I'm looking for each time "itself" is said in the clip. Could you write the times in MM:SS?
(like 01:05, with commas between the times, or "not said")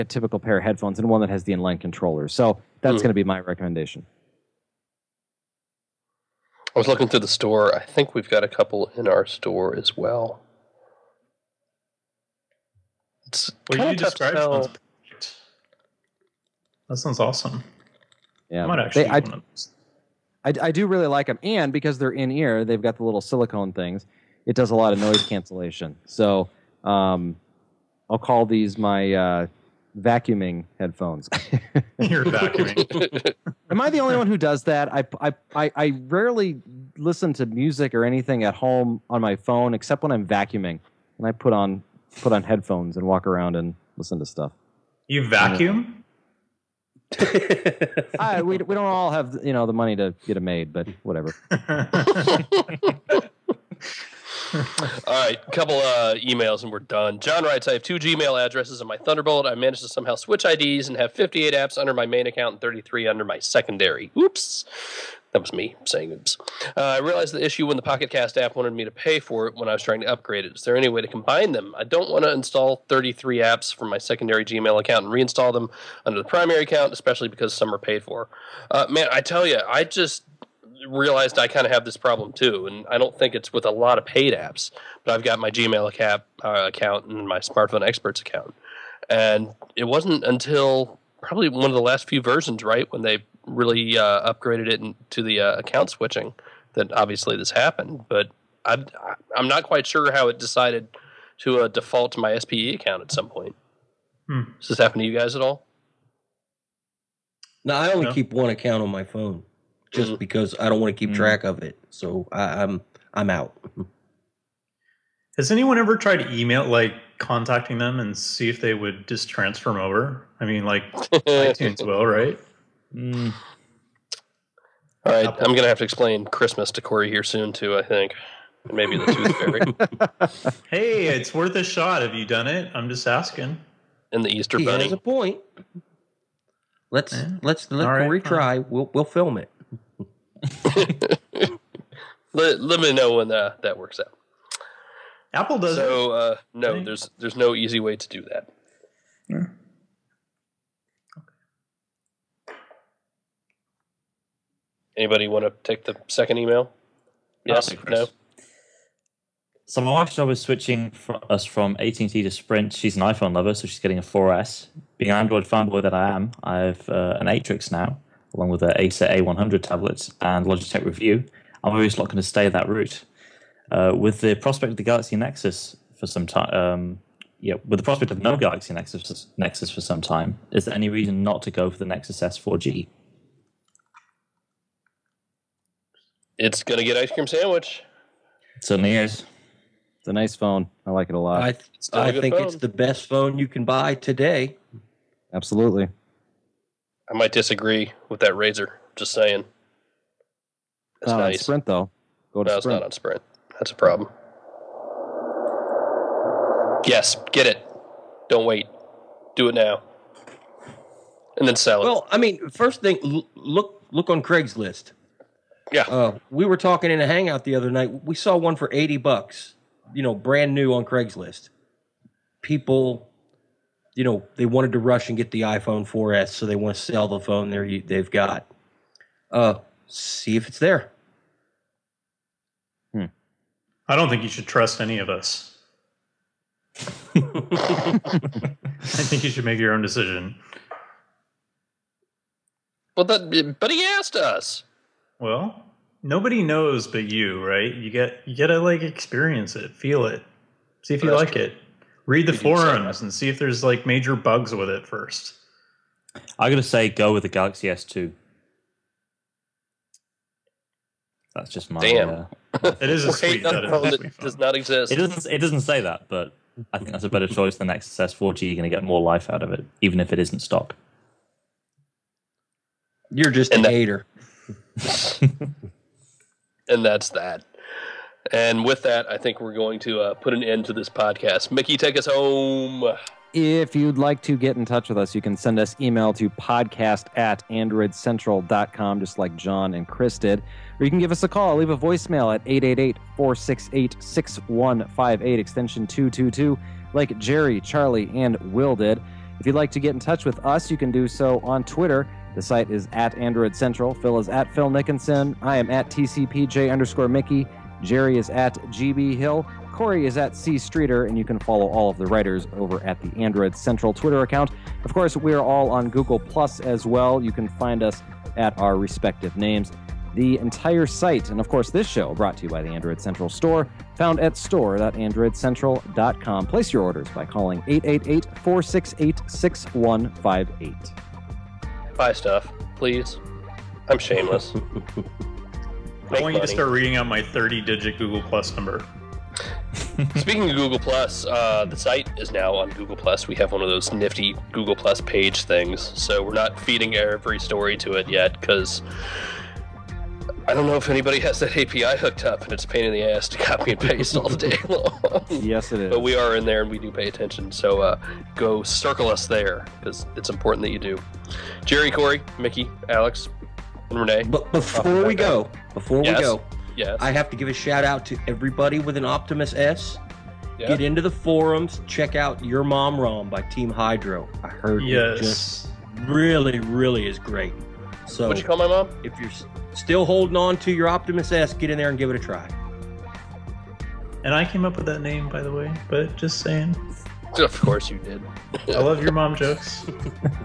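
not said.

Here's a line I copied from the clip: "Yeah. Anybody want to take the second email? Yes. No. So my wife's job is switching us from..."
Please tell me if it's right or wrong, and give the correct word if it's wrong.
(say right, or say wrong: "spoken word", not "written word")
right.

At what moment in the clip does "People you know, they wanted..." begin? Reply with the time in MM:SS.
03:42.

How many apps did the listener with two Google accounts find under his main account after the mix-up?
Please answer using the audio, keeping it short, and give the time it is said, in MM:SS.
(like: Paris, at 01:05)
58, at 01:01.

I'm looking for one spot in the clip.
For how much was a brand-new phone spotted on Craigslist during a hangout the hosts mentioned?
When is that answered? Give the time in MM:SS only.
03:38.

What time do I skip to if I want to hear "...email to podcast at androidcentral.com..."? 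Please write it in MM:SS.
04:45.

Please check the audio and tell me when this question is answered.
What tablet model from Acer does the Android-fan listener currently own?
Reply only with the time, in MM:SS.
02:48.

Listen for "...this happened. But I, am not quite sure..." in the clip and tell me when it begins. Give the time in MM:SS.
01:37.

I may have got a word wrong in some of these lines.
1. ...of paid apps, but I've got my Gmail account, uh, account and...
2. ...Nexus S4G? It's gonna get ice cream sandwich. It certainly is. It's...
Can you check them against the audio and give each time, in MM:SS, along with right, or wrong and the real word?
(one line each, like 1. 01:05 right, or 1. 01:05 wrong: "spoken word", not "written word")
1. 01:23 right
2. 03:01 right.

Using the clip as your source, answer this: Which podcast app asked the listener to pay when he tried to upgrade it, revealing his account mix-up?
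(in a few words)
Pocket Cast.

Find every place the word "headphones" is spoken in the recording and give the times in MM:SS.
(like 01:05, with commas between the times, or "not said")
00:00, 00:30, 00:42.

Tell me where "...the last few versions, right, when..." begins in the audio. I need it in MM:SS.
01:31.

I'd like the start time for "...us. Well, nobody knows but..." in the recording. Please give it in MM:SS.
04:04.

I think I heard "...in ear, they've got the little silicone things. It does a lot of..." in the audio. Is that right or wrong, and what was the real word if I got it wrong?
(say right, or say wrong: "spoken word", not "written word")
right.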